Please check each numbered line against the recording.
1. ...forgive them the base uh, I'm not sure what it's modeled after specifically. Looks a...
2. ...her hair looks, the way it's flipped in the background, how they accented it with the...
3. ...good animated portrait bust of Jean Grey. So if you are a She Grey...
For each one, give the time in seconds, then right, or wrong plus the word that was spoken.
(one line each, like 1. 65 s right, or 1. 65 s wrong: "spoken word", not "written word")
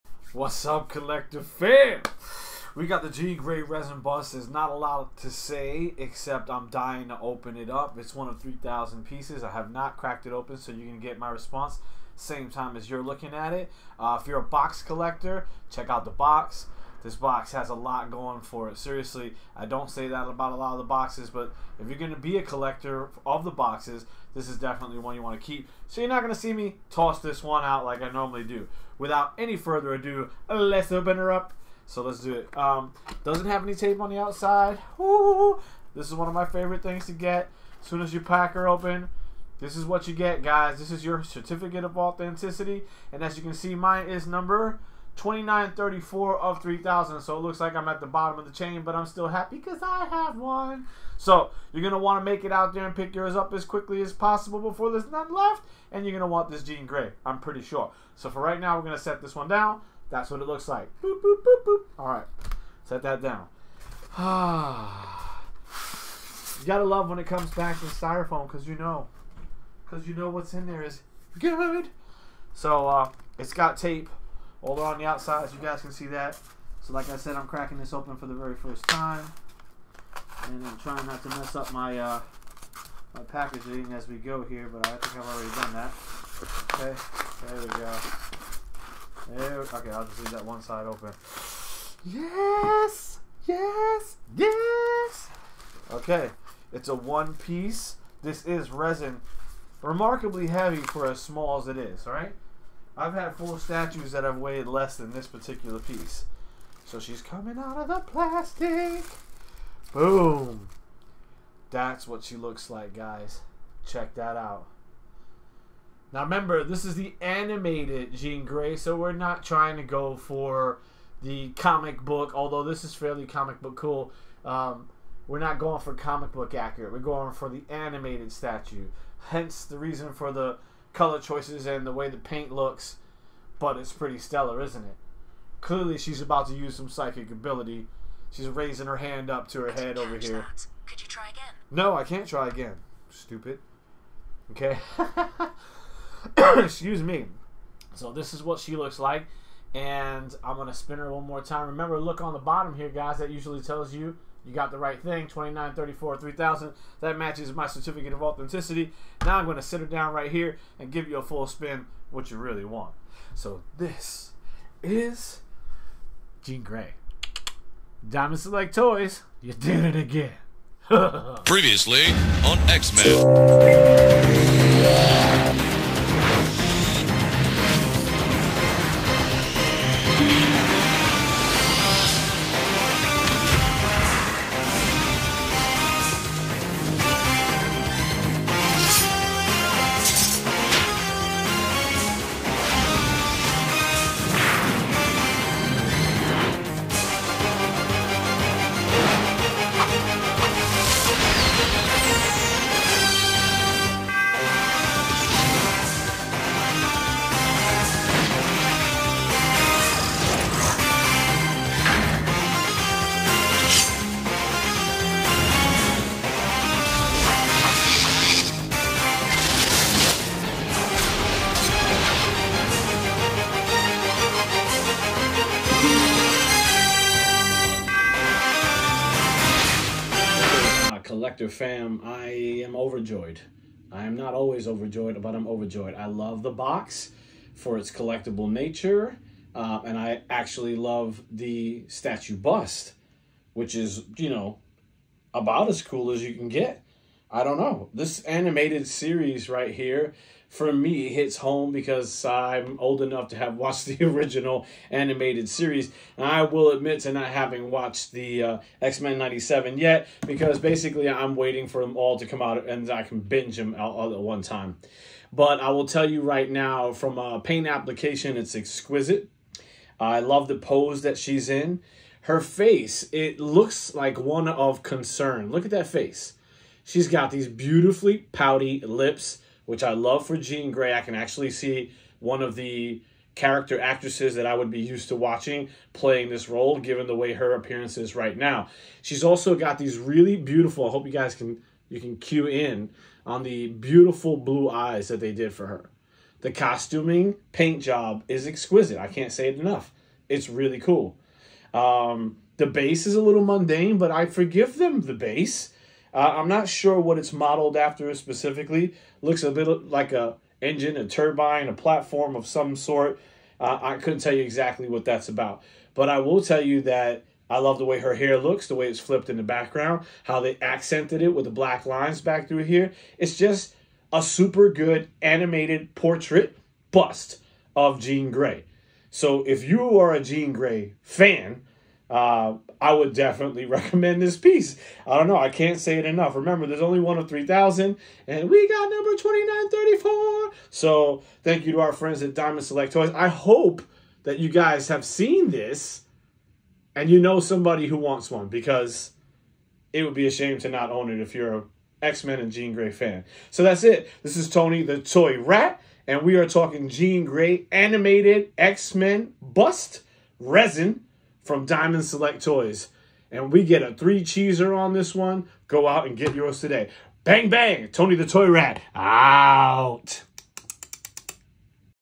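1. 304 s right
2. 317 s right
3. 324 s wrong: "Jean", not "She".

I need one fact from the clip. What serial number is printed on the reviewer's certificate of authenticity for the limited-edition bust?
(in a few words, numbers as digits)
2934.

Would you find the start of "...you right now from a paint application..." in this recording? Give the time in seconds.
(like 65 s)
266 s.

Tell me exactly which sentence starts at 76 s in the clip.
So like I said, I'm cracking this open for the very first time.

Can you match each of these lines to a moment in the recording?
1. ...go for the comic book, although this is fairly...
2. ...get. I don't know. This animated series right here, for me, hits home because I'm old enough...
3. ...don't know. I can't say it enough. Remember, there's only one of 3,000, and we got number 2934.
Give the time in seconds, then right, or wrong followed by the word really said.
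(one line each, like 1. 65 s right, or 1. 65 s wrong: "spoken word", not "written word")
1. 119 s right
2. 246 s right
3. 335 s right.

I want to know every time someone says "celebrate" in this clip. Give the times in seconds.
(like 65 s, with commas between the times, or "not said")
not said.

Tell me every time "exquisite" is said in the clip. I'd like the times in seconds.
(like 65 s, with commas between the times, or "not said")
268 s, 298 s.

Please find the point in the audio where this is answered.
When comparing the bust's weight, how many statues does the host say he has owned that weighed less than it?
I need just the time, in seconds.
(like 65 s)
103 s.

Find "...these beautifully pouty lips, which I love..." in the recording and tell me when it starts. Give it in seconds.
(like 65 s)
277 s.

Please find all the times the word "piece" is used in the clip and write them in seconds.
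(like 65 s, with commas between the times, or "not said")
9 s, 97 s, 105 s, 334 s.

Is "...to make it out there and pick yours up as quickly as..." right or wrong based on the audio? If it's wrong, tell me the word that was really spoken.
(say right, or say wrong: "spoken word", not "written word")
right.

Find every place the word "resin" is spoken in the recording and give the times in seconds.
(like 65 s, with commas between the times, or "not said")
3 s, 98 s, 360 s.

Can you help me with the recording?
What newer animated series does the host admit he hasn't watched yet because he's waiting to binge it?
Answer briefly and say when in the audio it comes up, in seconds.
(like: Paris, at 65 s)
X-Men 97, at 258 s.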